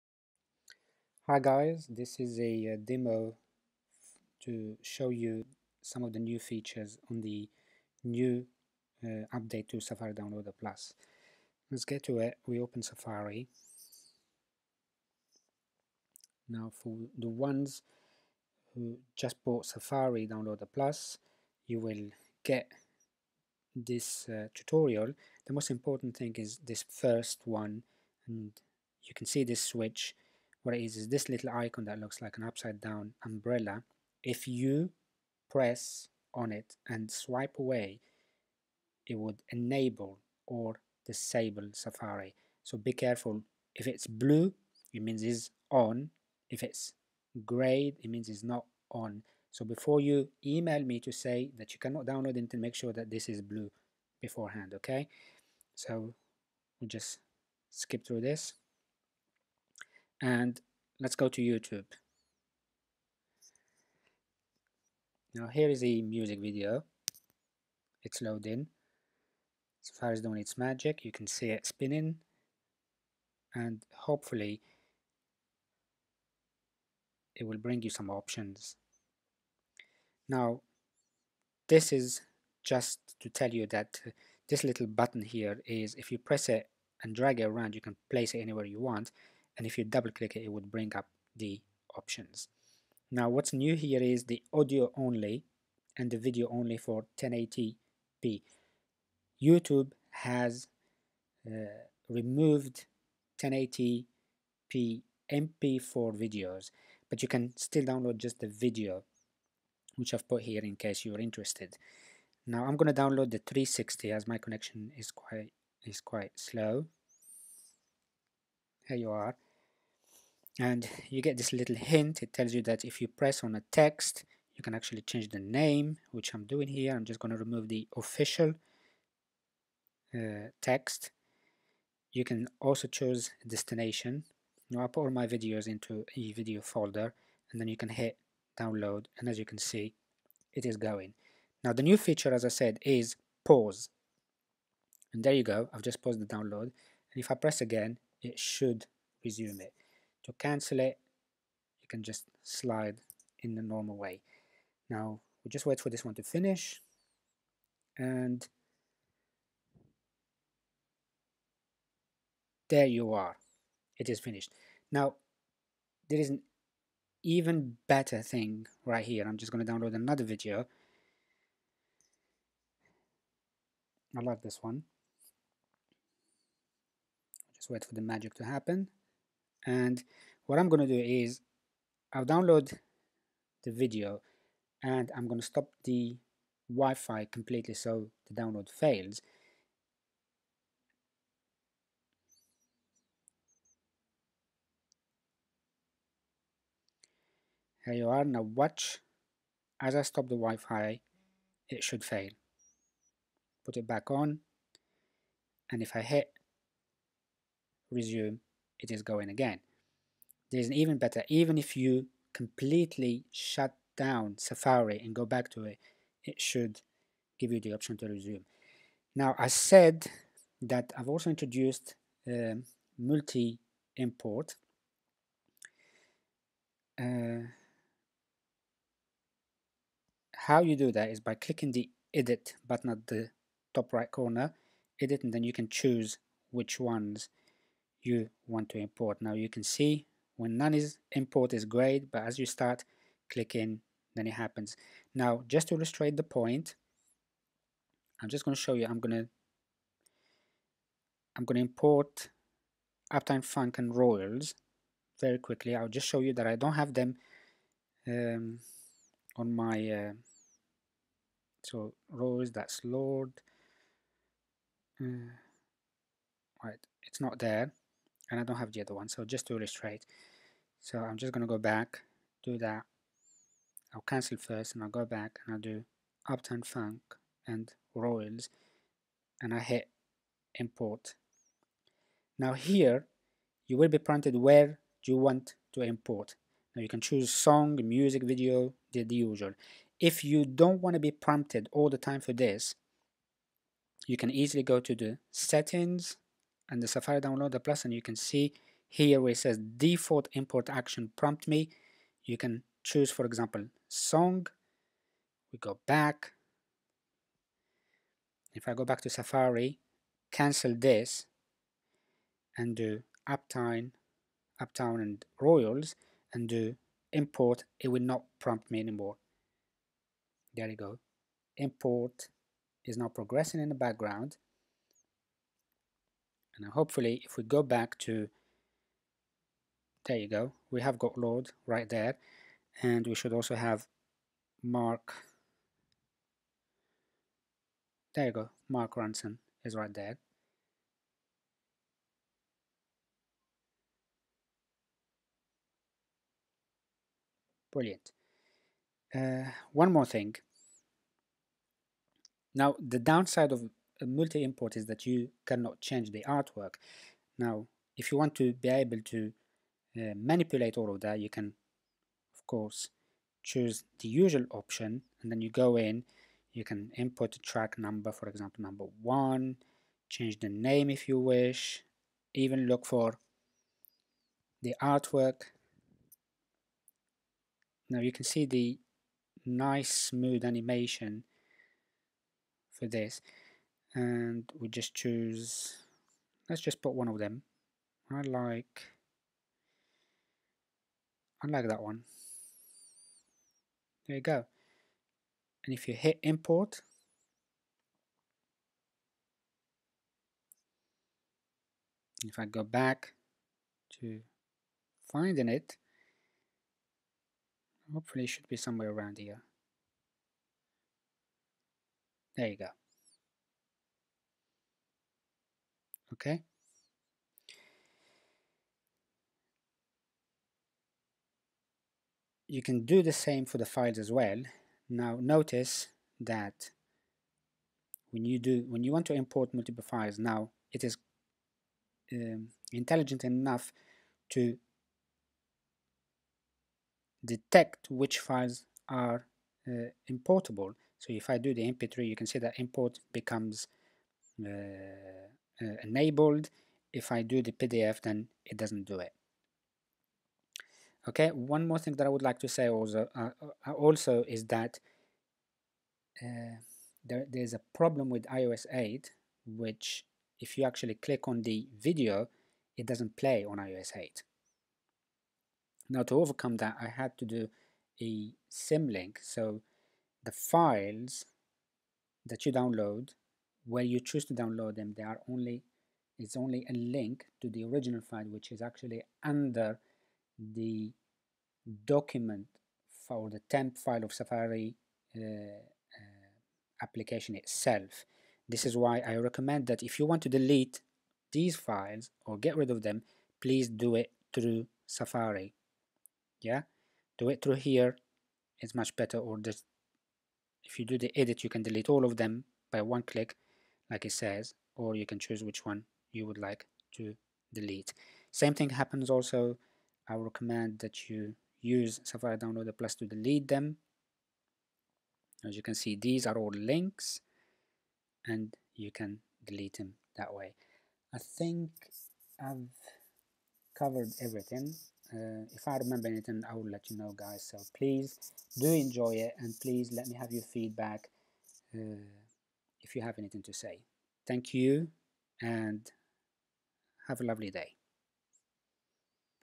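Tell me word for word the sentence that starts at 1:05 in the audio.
Now here is the music video.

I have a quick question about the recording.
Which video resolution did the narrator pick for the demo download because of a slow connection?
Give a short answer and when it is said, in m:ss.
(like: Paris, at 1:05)
360, at 1:53.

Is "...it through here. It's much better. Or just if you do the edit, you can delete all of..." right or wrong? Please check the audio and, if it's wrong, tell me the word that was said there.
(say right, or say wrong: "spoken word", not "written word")
right.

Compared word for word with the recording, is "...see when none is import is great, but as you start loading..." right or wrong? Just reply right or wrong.
wrong.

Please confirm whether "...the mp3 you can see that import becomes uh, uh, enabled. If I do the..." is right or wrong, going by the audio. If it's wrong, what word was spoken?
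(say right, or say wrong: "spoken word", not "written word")
right.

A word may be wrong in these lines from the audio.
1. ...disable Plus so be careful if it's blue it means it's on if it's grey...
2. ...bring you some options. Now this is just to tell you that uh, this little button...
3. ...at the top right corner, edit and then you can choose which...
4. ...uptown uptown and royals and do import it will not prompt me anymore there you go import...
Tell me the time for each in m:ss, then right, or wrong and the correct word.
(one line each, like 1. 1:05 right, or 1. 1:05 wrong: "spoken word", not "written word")
1. 0:41 wrong: "Safari", not "Plus"
2. 1:17 right
3. 3:52 right
4. 5:13 right.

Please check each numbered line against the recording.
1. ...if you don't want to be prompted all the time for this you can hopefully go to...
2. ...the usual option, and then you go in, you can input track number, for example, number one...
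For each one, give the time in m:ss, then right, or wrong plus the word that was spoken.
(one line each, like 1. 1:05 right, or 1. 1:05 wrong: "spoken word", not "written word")
1. 4:49 wrong: "easily", not "hopefully"
2. 6:03 right.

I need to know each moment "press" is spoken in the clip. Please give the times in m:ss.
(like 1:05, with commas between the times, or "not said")
0:35, 1:26, 2:03, 2:27.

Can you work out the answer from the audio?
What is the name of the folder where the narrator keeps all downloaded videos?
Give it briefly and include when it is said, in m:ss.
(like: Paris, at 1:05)
video folder, at 2:16.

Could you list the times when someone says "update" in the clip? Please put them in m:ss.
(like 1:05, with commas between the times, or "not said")
0:09.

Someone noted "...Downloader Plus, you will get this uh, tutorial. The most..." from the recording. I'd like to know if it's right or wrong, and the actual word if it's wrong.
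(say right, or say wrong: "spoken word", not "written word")
right.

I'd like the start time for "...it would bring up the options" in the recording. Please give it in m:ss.
1:30.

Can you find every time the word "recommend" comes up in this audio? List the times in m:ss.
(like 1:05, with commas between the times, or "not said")
8:09, 8:30.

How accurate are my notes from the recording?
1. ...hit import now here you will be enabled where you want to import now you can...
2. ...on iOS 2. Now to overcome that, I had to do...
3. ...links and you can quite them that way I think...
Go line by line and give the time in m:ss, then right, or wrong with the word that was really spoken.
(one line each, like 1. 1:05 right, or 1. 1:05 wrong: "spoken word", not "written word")
1. 4:39 wrong: "prompted", not "enabled"
2. 7:43 wrong: "8", not "2"
3. 8:36 wrong: "delete", not "quite".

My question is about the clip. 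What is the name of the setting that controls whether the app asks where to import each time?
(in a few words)
default import action.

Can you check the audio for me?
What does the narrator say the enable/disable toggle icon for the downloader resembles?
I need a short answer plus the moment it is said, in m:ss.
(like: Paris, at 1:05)
upside down umbrella, at 0:32.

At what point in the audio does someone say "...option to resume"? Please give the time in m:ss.
3:37.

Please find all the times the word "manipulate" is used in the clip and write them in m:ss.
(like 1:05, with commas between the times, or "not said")
6:00.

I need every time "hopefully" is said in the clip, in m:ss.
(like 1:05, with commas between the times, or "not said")
1:13, 5:26, 6:47.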